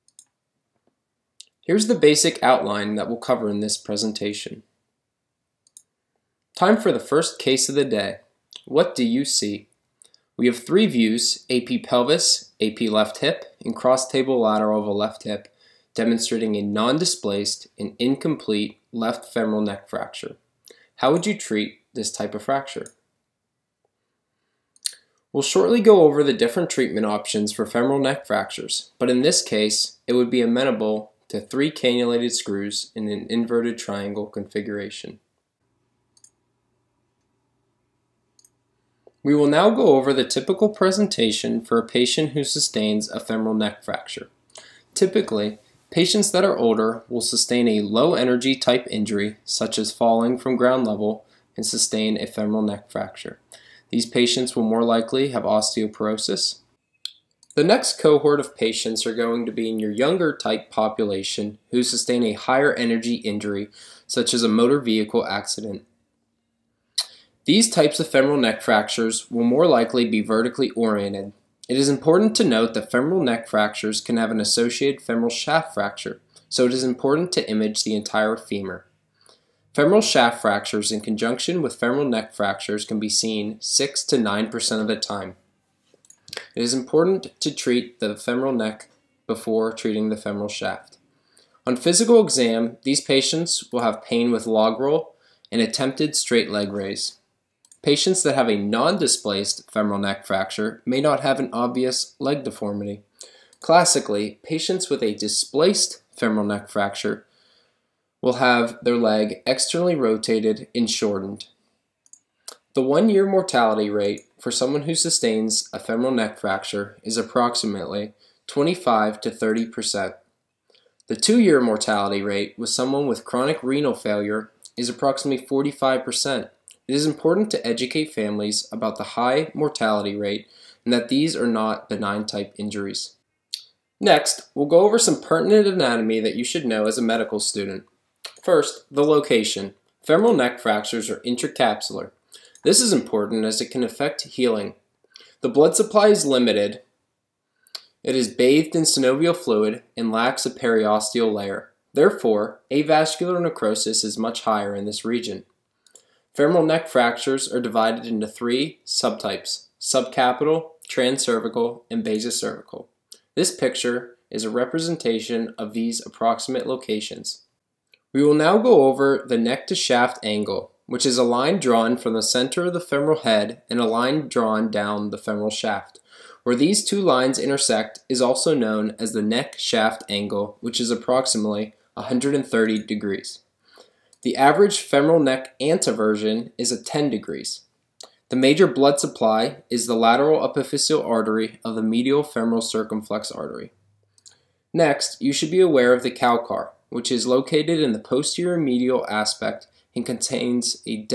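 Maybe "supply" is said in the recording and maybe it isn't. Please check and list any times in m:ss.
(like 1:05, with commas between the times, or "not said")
2:25, 3:08.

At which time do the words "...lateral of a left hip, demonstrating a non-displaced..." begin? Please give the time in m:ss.
0:14.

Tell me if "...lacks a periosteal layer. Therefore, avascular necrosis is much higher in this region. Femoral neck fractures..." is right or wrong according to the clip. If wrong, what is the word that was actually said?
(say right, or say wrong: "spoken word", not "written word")
right.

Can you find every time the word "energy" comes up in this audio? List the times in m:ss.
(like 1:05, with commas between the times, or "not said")
0:48, 1:02.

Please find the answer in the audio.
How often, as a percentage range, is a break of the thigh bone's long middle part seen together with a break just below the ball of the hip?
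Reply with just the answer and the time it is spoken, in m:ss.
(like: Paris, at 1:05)
6 to 9%, at 1:23.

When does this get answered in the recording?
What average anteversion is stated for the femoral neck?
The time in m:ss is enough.
3:06.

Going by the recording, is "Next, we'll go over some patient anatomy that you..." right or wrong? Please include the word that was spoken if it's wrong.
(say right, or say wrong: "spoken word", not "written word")
wrong: "pertinent", not "patient".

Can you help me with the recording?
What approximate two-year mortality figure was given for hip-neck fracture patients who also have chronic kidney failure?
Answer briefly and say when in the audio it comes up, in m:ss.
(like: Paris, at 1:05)
45 percent, at 2:05.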